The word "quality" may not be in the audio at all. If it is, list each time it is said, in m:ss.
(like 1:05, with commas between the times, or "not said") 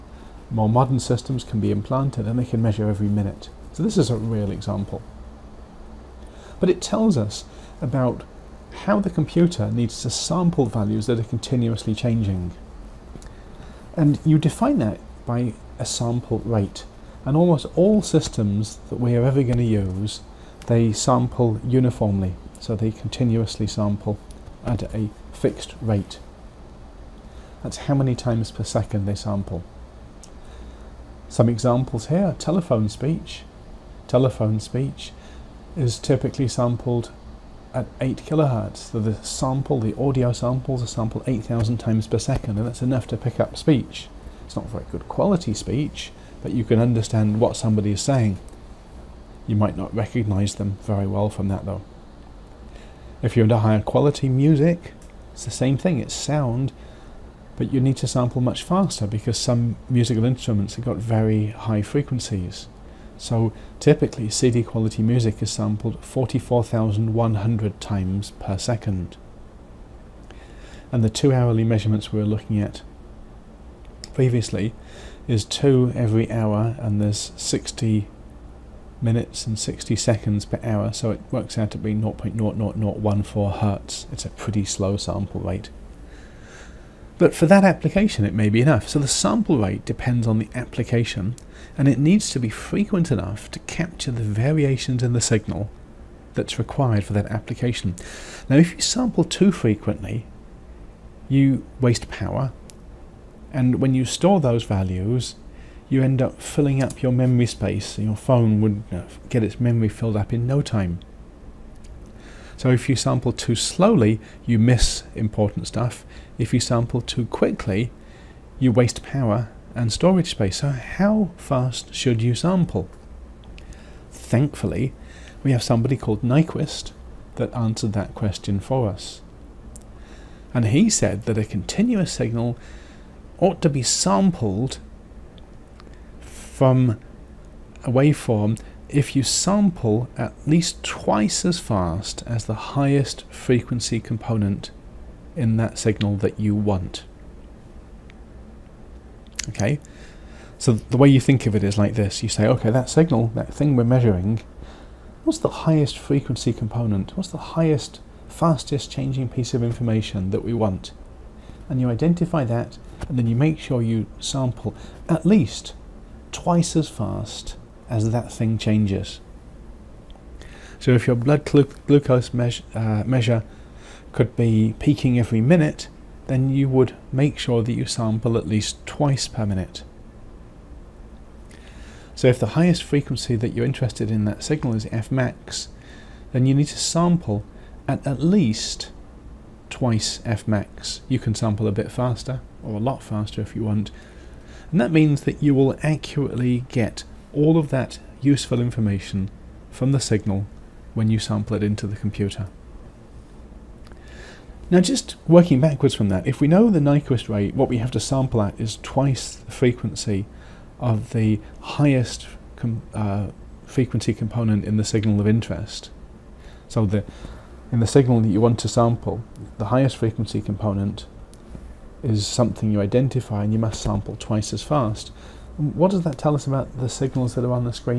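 0:45, 0:53, 1:04.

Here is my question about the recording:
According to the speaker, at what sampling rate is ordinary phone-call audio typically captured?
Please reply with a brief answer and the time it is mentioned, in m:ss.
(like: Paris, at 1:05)
8 kilohertz, at 0:37.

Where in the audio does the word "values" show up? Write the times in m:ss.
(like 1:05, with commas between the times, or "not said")
0:10, 1:44.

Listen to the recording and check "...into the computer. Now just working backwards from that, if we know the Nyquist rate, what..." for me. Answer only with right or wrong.
right.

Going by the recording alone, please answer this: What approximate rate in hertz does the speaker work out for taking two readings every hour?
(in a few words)
0.0014 hertz.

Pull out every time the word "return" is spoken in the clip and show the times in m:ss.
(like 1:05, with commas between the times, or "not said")
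not said.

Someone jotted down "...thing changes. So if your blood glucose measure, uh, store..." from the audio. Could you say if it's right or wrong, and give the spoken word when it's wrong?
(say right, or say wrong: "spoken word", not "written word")
wrong: "measure", not "store".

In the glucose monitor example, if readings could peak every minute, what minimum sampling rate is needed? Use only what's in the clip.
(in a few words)
twice per minute.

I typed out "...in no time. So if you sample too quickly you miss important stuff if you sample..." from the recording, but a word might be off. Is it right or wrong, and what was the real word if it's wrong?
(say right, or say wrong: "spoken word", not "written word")
wrong: "slowly", not "quickly".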